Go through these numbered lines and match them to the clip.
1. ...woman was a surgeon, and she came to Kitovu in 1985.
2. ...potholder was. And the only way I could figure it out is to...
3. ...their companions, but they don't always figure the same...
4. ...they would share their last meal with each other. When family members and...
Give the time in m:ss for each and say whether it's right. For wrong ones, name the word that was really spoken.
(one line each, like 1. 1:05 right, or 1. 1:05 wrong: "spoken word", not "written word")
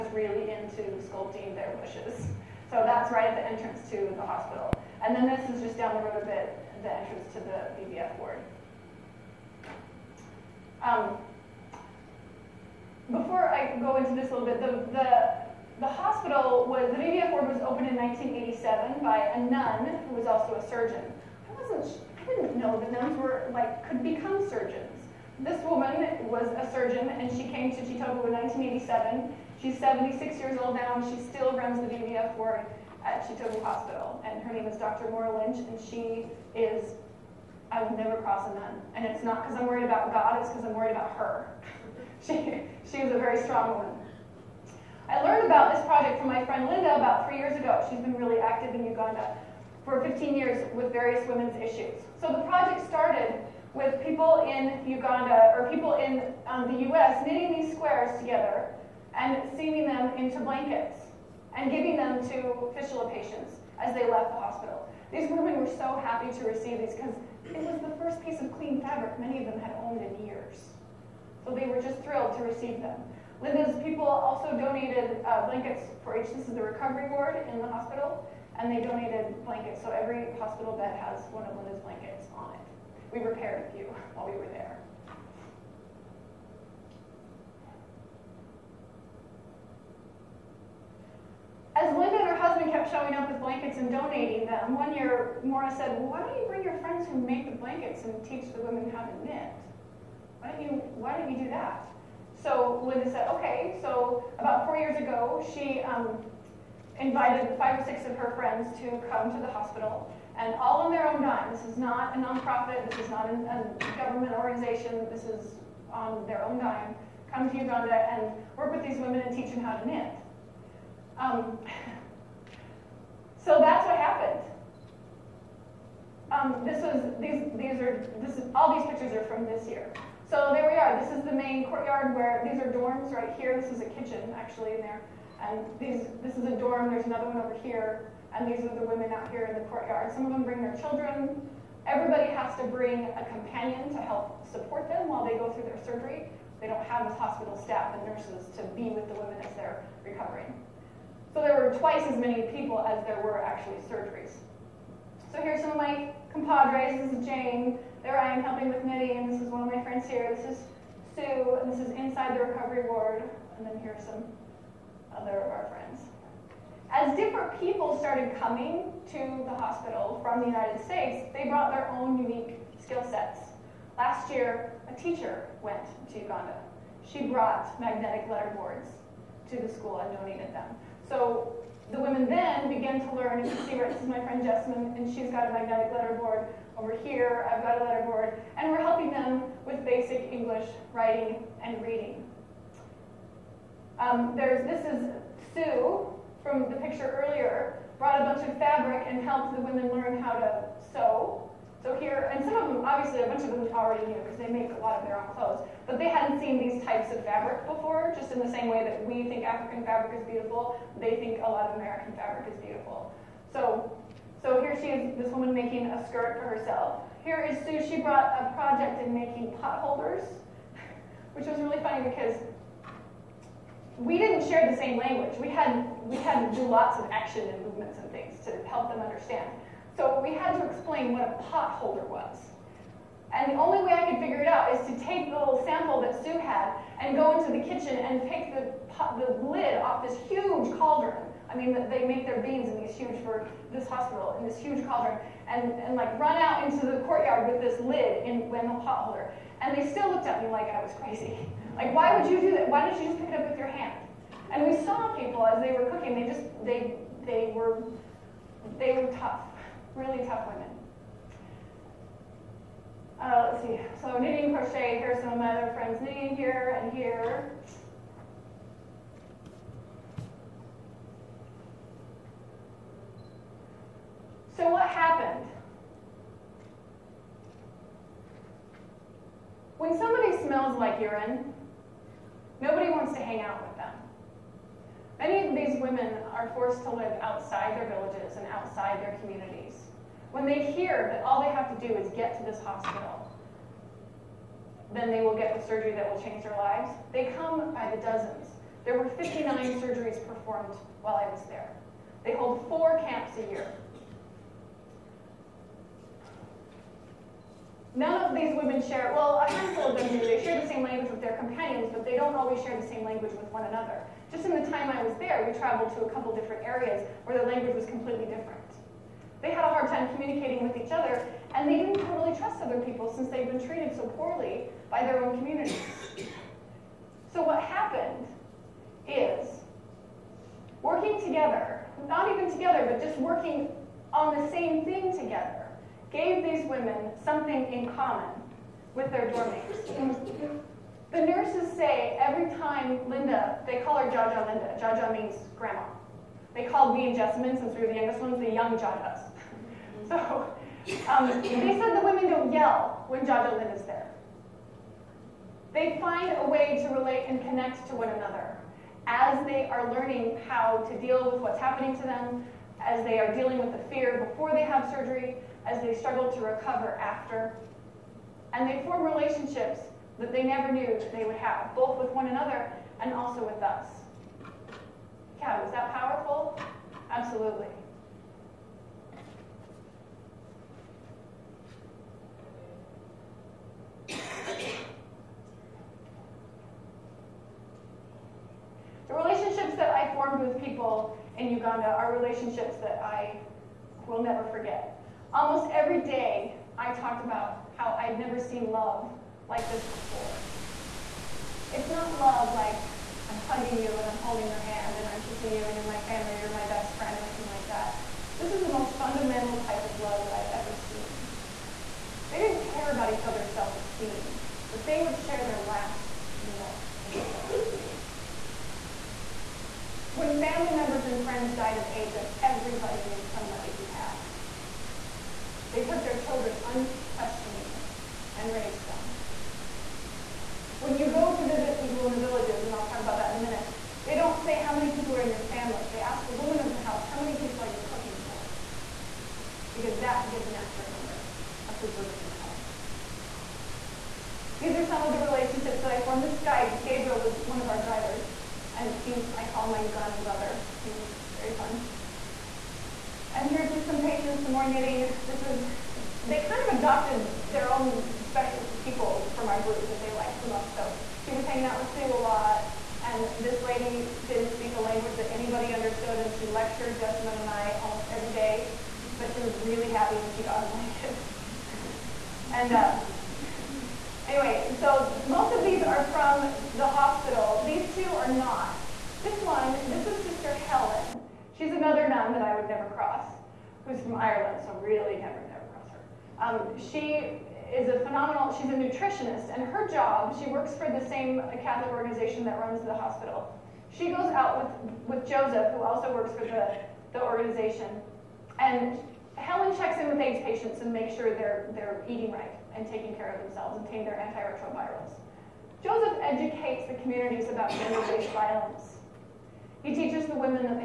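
1. 0:25 wrong: "1987", not "1985"
2. 3:51 right
3. 5:11 wrong: "share", not "figure"
4. 6:54 right.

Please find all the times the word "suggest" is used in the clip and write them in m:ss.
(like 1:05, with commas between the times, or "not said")
not said.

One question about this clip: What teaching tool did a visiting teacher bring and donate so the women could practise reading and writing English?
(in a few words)
magnetic letter boards.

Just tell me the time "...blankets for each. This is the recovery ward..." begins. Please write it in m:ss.
1:15.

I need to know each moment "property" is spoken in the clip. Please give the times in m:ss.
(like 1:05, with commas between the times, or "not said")
not said.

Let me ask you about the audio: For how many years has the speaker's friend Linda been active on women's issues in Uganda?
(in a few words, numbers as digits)
15 years.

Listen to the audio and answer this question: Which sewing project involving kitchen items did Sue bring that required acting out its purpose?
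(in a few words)
potholders.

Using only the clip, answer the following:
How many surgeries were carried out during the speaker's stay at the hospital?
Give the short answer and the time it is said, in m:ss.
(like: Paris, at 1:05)
59, at 4:59.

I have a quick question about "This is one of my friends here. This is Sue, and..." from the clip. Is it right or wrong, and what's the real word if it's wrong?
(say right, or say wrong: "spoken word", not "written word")
right.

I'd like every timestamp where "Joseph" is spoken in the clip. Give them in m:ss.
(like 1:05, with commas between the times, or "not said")
8:15, 8:25.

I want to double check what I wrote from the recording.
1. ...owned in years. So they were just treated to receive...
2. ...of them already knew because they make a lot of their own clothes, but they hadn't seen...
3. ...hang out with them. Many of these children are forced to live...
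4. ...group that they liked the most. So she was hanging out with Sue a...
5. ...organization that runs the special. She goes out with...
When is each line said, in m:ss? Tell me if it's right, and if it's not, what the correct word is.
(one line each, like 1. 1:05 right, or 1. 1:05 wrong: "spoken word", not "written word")
1. 1:09 wrong: "thrilled", not "treated"
2. 3:23 right
3. 4:43 wrong: "women", not "children"
4. 7:39 right
5. 8:11 wrong: "hospital", not "special".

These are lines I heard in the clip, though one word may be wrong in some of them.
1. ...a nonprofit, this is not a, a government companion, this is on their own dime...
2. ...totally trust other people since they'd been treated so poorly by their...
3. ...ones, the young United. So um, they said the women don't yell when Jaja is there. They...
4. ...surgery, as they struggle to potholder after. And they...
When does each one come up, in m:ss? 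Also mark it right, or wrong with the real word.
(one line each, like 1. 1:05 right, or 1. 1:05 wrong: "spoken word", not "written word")
1. 1:52 wrong: "organization", not "companion"
2. 5:22 right
3. 5:48 wrong: "Jajas", not "United"
4. 6:04 wrong: "recover", not "potholder".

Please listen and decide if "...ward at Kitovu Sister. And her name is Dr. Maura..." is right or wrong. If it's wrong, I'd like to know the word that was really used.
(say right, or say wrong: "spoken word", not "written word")
wrong: "Hospital", not "Sister".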